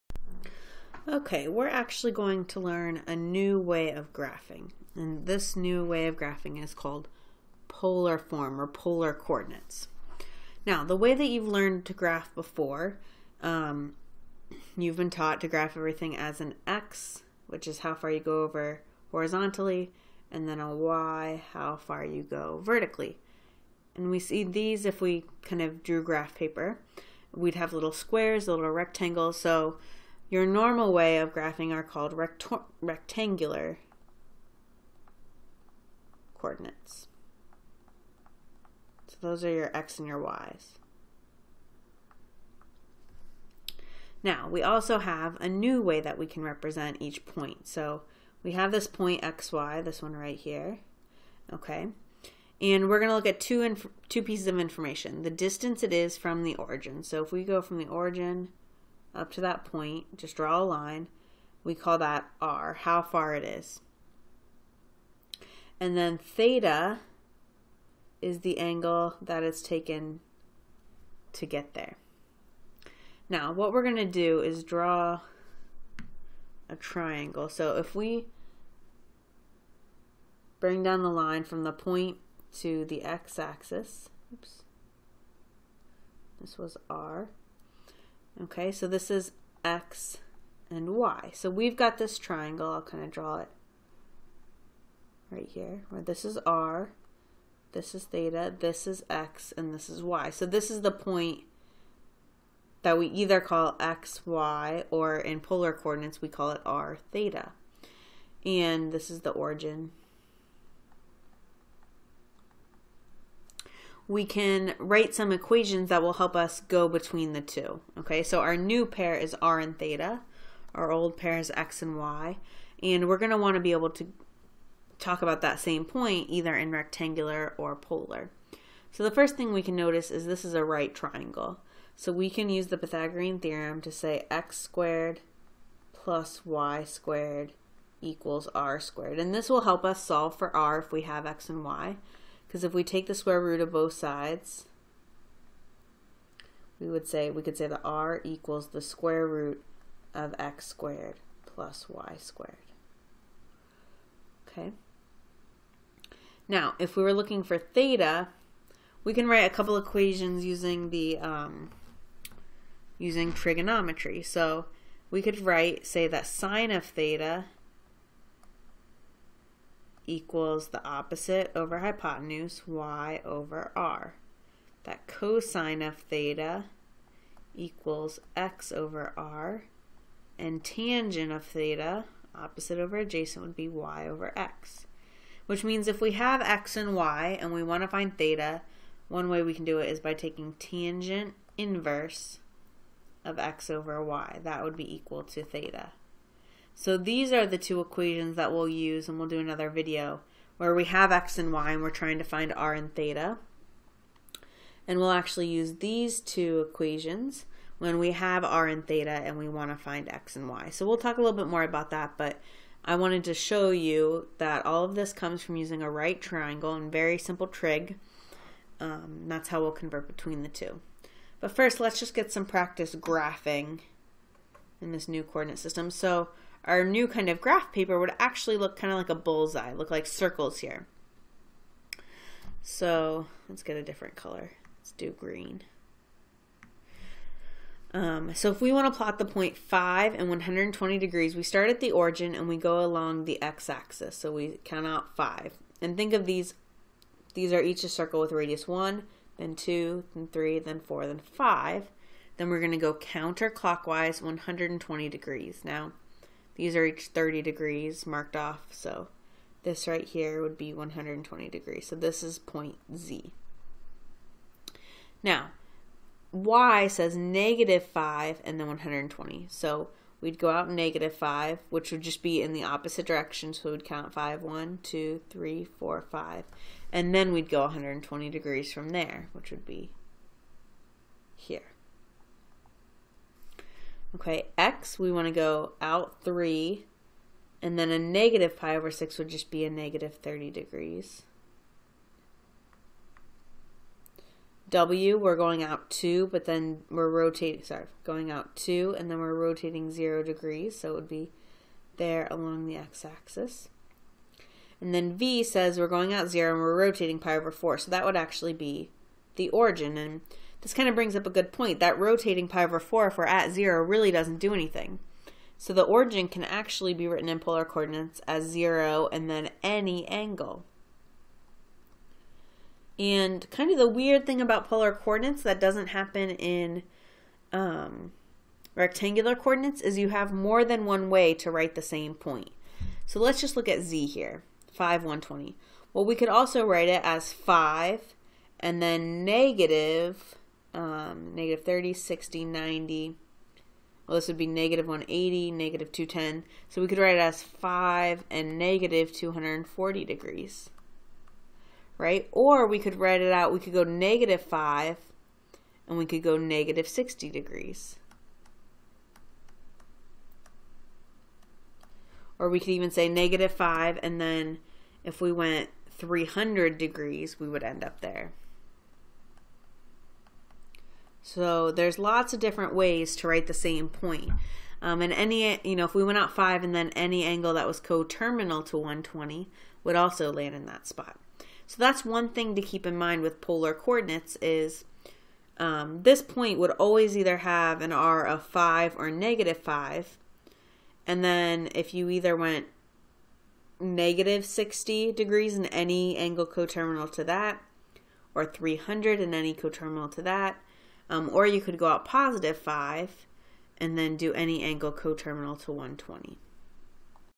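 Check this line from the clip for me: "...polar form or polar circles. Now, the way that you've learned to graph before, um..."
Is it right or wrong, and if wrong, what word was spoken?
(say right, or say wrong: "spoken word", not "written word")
wrong: "coordinates", not "circles".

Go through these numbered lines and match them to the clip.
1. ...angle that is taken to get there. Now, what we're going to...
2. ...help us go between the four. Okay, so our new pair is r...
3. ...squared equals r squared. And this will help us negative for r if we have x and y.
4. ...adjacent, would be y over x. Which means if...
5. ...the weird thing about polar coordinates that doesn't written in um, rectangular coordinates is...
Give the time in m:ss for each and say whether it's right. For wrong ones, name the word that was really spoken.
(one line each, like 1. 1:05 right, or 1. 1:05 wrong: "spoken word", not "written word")
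1. 1:08 right
2. 1:56 wrong: "two", not "four"
3. 2:16 wrong: "solve", not "negative"
4. 3:02 right
5. 5:23 wrong: "happen", not "written".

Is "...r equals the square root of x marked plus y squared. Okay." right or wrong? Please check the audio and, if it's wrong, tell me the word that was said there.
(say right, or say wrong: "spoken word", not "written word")
wrong: "squared", not "marked".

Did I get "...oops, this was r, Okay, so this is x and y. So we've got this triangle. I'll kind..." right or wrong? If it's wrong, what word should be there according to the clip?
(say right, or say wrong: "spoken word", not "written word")
right.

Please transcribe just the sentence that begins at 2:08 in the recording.
So the first thing we can notice is this is a right triangle.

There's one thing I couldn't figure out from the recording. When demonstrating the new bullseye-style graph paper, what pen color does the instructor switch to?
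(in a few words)
green.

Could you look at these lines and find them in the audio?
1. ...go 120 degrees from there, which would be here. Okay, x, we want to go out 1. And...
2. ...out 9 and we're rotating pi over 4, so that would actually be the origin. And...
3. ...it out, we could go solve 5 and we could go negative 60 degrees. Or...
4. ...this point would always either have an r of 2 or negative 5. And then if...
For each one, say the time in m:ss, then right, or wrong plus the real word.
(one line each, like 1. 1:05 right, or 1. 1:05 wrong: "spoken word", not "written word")
1. 4:37 wrong: "3", not "1"
2. 5:06 wrong: "0", not "9"
3. 5:53 wrong: "negative", not "solve"
4. 6:26 wrong: "5", not "2".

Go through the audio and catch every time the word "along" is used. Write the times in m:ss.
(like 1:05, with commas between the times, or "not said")
4:02, 5:02.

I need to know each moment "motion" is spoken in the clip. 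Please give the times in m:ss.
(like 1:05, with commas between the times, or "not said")
not said.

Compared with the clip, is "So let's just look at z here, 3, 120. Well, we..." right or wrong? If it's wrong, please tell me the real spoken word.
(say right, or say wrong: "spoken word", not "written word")
wrong: "5", not "3".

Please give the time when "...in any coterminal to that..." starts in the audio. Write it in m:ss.
6:39.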